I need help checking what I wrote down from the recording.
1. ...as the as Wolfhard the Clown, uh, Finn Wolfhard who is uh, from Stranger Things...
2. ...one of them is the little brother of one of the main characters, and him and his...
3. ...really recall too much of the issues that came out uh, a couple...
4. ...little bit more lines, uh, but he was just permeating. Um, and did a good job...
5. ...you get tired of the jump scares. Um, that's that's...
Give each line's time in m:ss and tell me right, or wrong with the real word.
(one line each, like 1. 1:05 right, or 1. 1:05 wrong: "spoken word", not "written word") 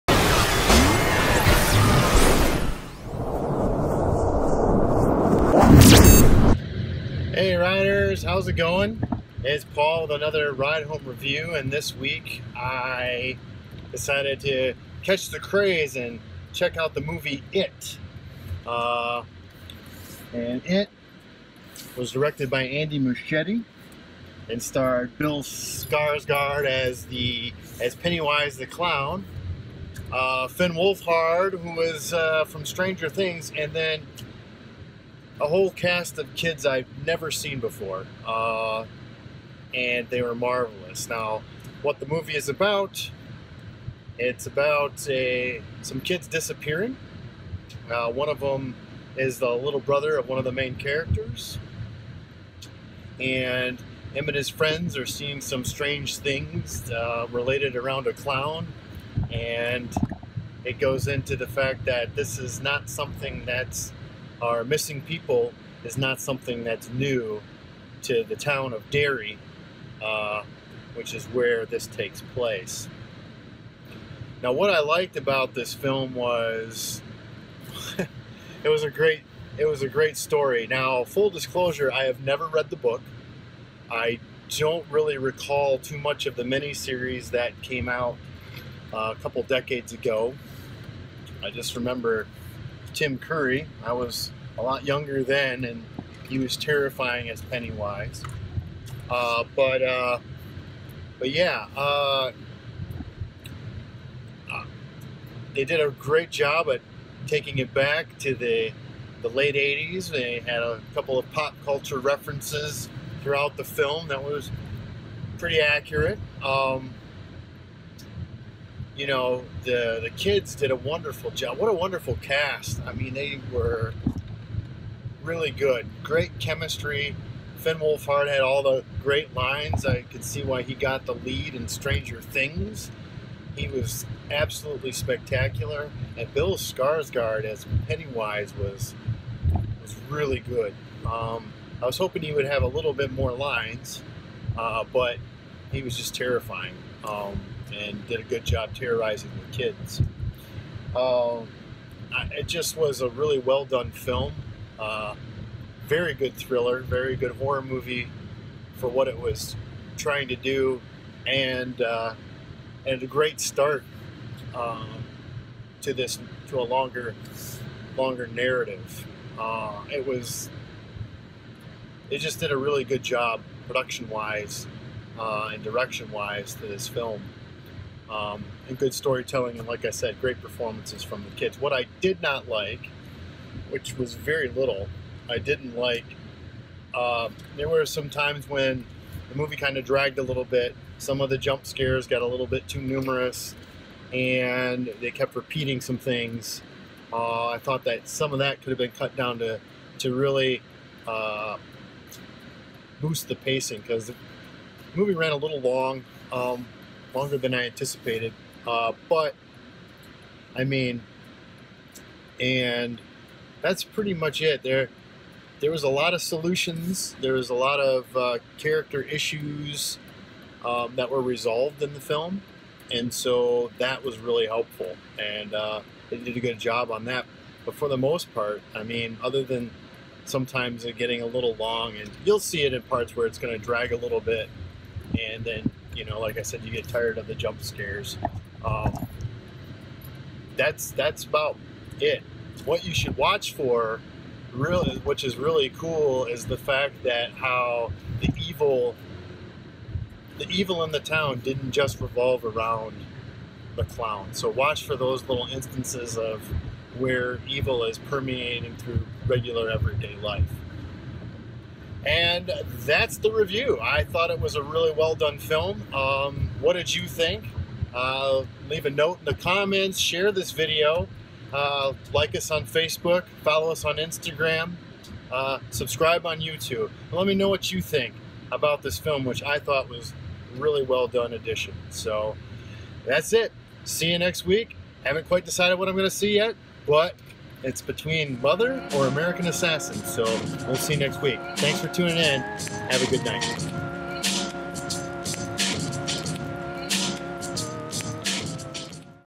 1. 0:26 wrong: "Pennywise", not "Wolfhard"
2. 0:48 right
3. 1:24 wrong: "miniseries", not "issues"
4. 2:22 wrong: "terrifying", not "permeating"
5. 3:56 right.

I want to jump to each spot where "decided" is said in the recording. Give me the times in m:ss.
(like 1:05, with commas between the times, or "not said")
0:13, 4:45.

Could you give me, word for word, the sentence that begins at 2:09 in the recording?
I could see why he got the lead in Stranger Things.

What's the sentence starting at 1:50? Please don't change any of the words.
They had a couple of pop culture references throughout the film that was pretty accurate.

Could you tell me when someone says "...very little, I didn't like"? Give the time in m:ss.
3:04.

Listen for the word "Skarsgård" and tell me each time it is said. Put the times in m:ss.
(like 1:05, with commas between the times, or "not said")
0:25, 2:16.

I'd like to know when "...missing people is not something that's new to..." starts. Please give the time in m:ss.
1:04.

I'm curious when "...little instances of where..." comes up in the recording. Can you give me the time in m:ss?
4:15.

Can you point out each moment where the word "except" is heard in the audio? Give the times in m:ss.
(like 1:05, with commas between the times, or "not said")
not said.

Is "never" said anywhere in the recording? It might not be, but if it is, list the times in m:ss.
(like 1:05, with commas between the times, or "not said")
0:37, 1:22.